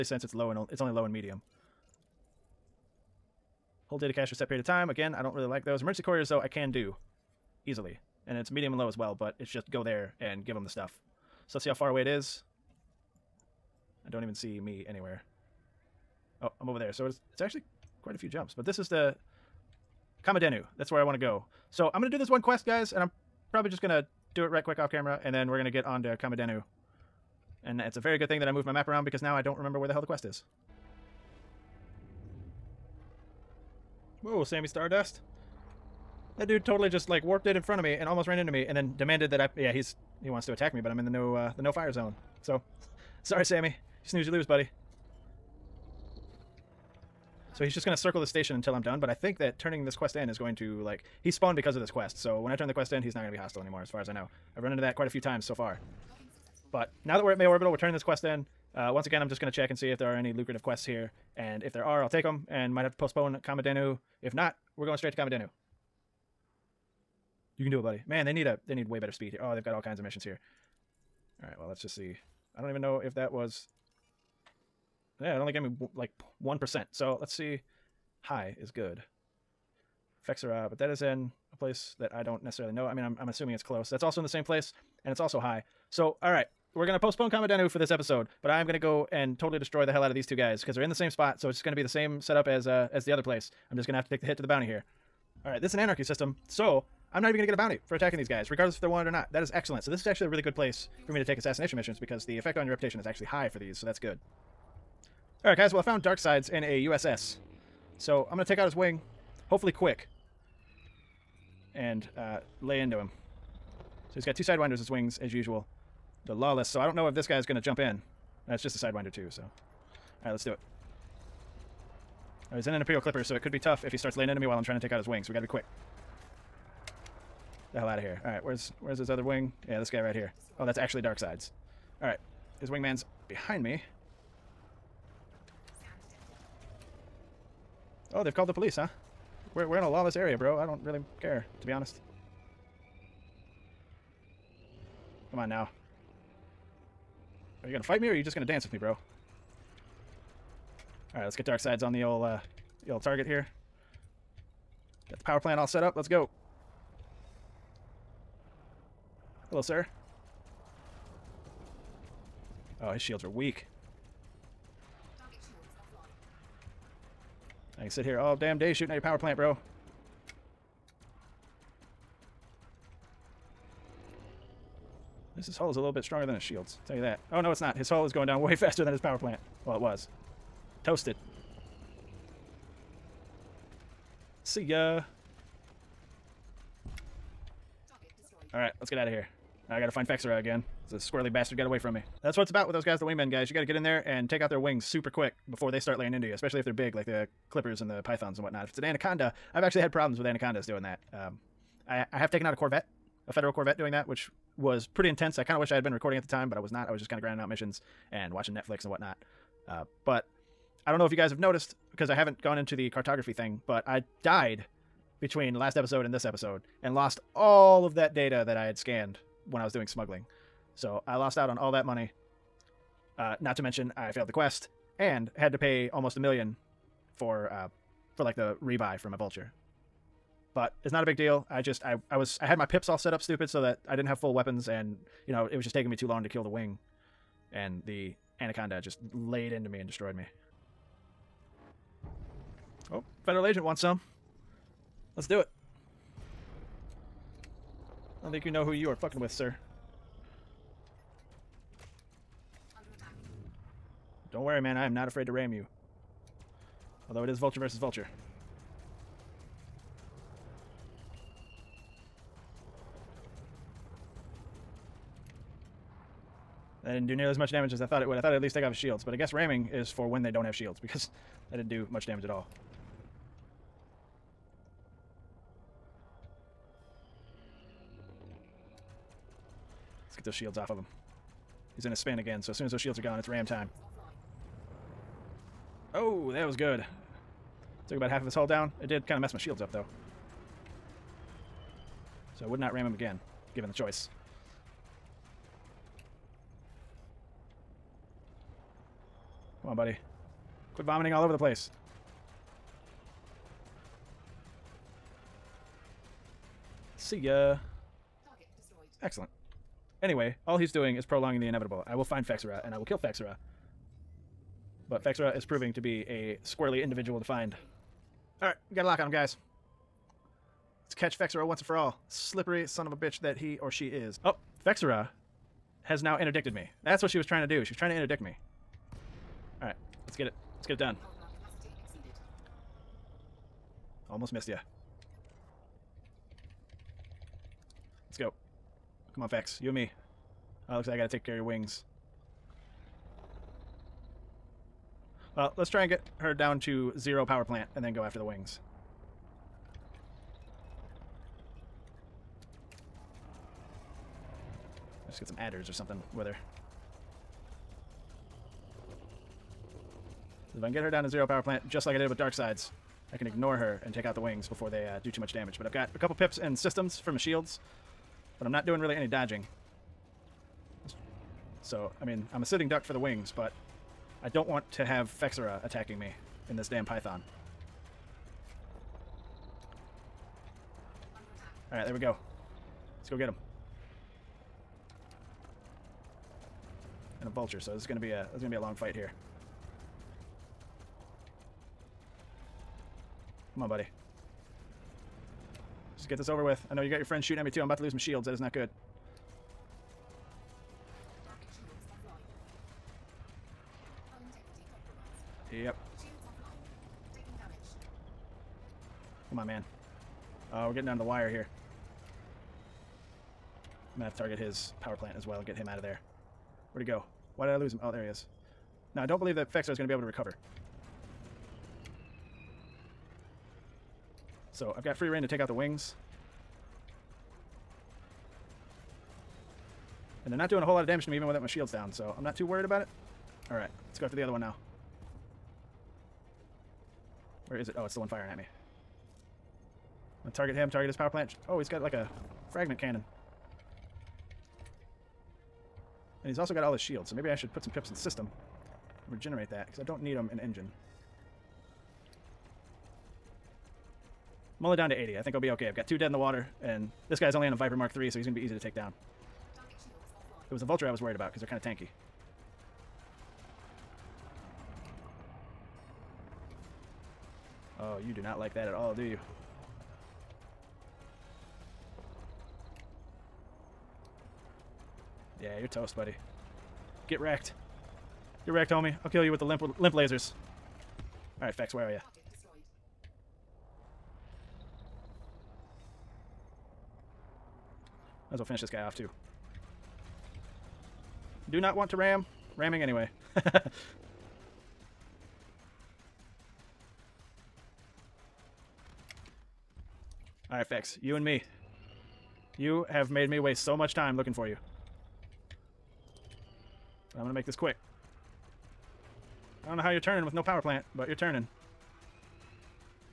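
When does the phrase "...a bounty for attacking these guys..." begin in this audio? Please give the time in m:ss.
1:37.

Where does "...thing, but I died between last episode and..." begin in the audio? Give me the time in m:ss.
3:33.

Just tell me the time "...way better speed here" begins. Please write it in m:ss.
1:08.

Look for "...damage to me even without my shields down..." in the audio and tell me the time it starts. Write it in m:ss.
7:10.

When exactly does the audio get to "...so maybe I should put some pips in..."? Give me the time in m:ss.
7:27.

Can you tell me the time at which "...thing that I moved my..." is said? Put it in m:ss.
0:28.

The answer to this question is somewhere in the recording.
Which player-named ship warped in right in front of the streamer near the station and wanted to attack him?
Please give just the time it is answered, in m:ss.
0:34.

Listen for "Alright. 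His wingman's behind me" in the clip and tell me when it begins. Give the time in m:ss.
2:12.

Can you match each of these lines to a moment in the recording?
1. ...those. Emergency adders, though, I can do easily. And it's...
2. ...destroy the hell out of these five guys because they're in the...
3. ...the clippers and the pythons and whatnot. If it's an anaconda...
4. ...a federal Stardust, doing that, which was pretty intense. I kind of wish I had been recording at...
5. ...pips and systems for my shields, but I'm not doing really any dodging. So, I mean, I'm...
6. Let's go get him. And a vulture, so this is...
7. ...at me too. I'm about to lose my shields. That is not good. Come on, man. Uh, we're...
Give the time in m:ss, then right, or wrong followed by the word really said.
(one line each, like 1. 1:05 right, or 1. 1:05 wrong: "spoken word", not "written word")
1. 0:05 wrong: "couriers", not "adders"
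2. 1:29 wrong: "two", not "five"
3. 3:17 right
4. 3:23 wrong: "Corvette", not "Stardust"
5. 6:06 right
6. 6:23 right
7. 6:37 right.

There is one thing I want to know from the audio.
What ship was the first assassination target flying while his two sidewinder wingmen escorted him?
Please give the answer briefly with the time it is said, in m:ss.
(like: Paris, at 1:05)
Imperial Clipper, at 2:02.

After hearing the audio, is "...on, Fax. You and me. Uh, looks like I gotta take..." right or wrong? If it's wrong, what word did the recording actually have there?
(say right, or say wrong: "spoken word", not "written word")
right.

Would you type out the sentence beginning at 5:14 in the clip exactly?
But Fexera is proving to be a squarely individual to find.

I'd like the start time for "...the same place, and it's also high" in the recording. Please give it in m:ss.
1:24.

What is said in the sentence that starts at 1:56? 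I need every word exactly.
So I don't know if this guy's going to jump in.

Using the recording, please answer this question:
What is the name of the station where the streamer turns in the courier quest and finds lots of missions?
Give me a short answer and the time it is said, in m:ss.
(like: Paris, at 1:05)
May Orbital, at 0:57.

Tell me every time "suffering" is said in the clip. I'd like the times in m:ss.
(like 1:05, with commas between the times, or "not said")
not said.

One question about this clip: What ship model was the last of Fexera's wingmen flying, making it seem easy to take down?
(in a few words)
Viper Mark III.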